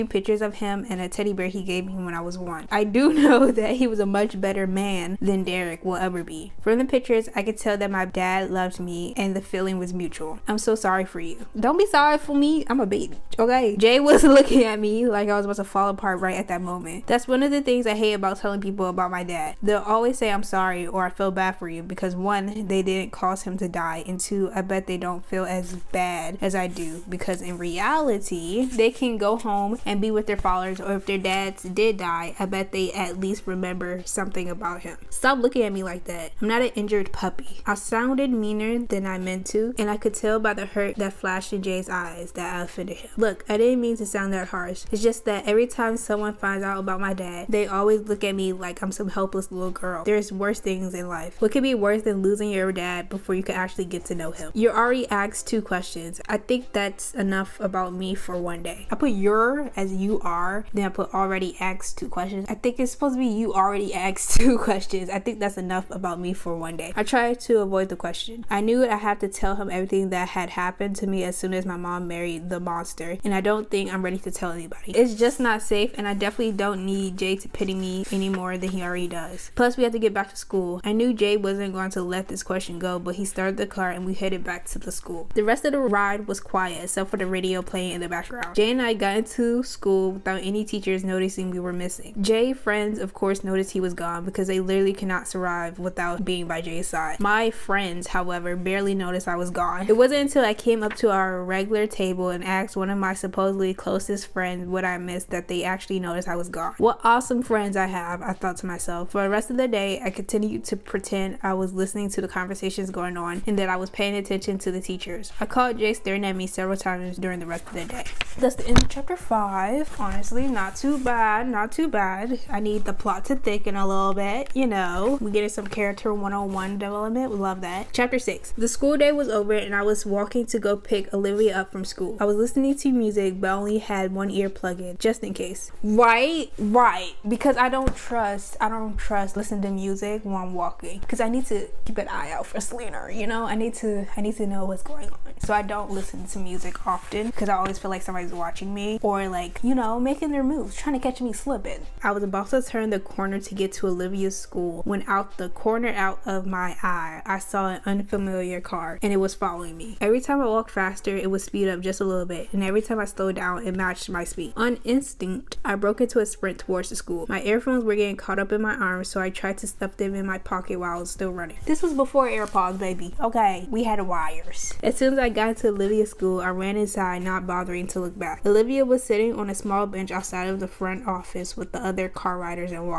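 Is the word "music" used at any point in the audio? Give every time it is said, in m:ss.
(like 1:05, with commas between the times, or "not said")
2:12, 2:19, 2:26.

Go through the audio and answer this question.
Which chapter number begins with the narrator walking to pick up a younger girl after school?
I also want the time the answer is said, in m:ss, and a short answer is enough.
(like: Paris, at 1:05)
6, at 2:07.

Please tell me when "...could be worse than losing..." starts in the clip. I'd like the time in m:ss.
0:51.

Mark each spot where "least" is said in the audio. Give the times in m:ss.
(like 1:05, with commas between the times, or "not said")
0:33.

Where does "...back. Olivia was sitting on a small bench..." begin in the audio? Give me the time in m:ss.
2:58.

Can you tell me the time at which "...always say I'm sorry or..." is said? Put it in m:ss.
0:19.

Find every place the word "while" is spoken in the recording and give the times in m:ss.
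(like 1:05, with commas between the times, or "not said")
2:20, 2:50.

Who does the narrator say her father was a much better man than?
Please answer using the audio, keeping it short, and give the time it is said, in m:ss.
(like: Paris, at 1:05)
Derek, at 0:05.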